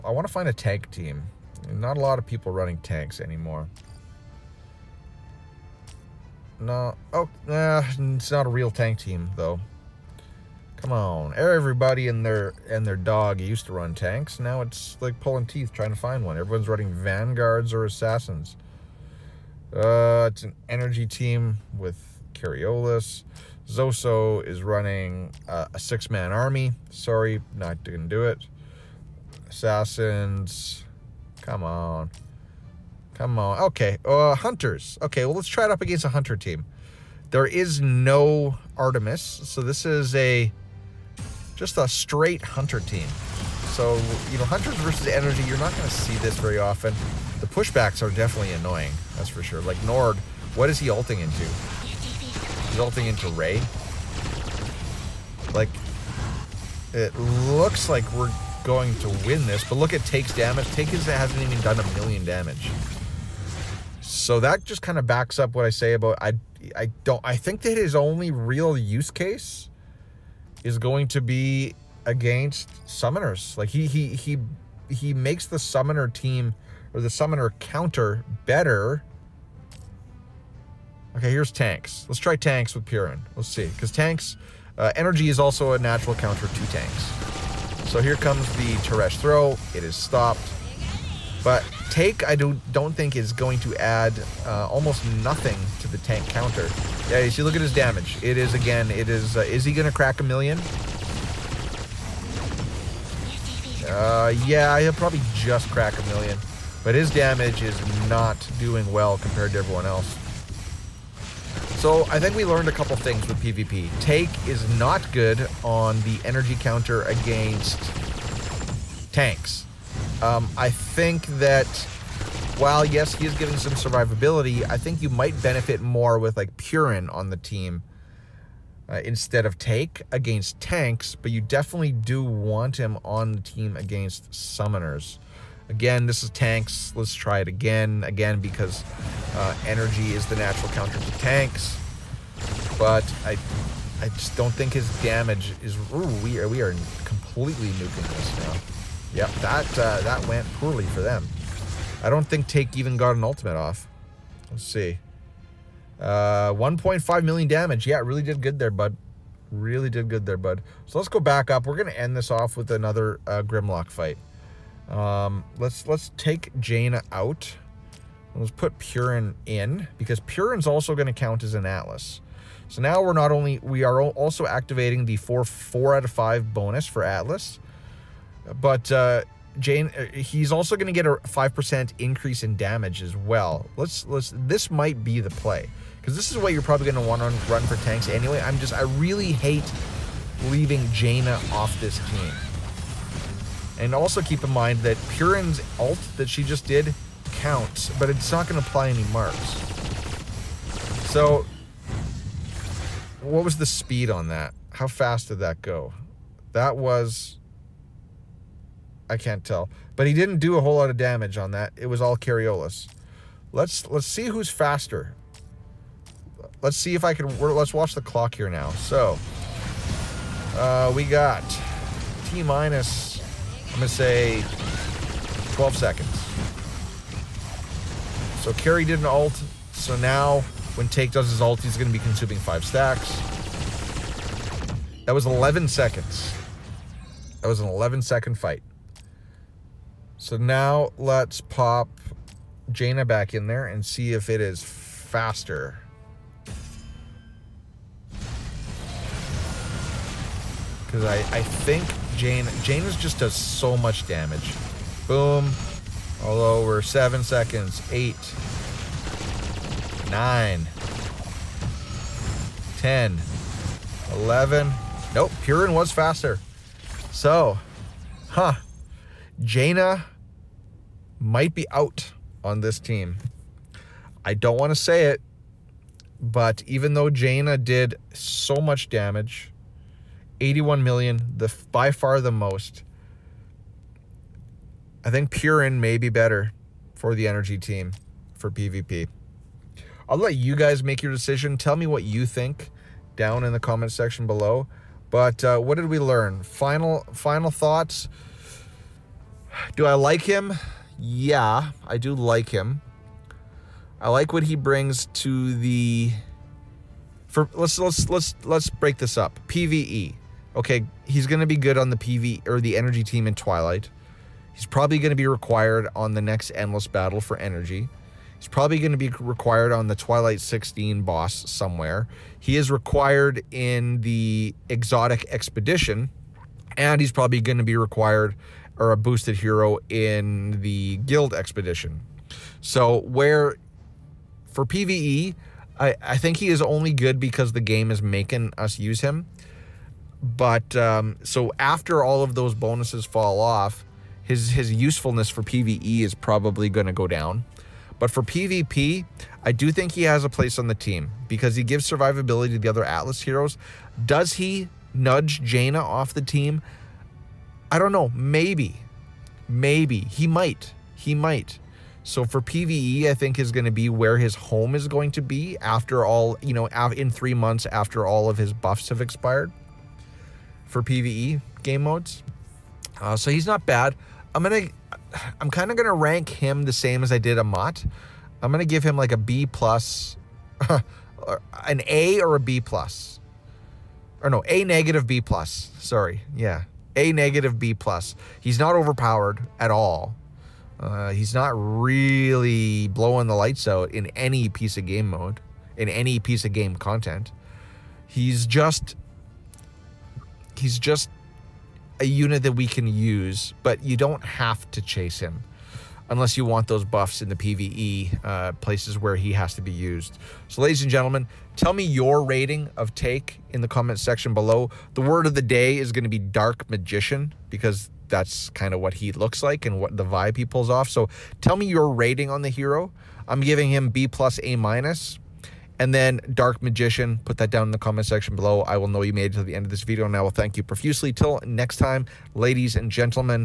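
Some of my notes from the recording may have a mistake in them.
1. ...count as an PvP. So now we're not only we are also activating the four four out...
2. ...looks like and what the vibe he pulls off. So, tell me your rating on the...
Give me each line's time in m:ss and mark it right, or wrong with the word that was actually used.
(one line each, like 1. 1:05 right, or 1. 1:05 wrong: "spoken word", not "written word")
1. 2:51 wrong: "Atlas", not "PvP"
2. 6:59 right.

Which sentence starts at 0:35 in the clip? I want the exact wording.
Okay, well, let's try it up against a hunter team.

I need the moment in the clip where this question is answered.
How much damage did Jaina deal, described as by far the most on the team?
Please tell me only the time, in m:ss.
4:40.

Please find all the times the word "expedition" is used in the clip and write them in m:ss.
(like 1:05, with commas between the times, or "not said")
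5:25, 5:31.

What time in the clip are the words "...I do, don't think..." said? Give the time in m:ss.
1:32.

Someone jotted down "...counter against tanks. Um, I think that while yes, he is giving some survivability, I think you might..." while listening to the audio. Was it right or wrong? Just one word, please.
right.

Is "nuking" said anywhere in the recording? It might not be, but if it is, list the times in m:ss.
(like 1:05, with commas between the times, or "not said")
2:27.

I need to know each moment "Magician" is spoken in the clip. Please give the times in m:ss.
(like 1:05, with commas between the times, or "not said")
6:56, 7:06.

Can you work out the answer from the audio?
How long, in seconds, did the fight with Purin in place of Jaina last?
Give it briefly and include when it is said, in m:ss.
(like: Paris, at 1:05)
11 seconds, at 3:57.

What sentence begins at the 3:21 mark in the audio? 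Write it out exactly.
So, what was the speed on that?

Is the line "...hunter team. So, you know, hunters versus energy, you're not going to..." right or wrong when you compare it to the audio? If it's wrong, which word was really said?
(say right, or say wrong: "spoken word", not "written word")
right.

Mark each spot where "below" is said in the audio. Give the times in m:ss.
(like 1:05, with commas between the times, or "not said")
4:54, 6:54, 7:08.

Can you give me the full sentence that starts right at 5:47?
But for PvP, I do think he has a place on the team because he gives survivability to the other Atlas heroes.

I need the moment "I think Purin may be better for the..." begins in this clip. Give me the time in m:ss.
4:45.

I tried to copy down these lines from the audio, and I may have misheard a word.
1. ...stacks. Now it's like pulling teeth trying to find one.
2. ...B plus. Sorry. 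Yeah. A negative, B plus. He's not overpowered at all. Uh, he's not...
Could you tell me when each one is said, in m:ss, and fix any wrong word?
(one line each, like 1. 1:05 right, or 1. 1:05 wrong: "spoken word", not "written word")
1. 0:13 wrong: "tanks", not "stacks"
2. 6:25 right.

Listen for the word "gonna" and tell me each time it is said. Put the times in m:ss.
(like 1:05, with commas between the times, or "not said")
0:27, 3:43, 3:51.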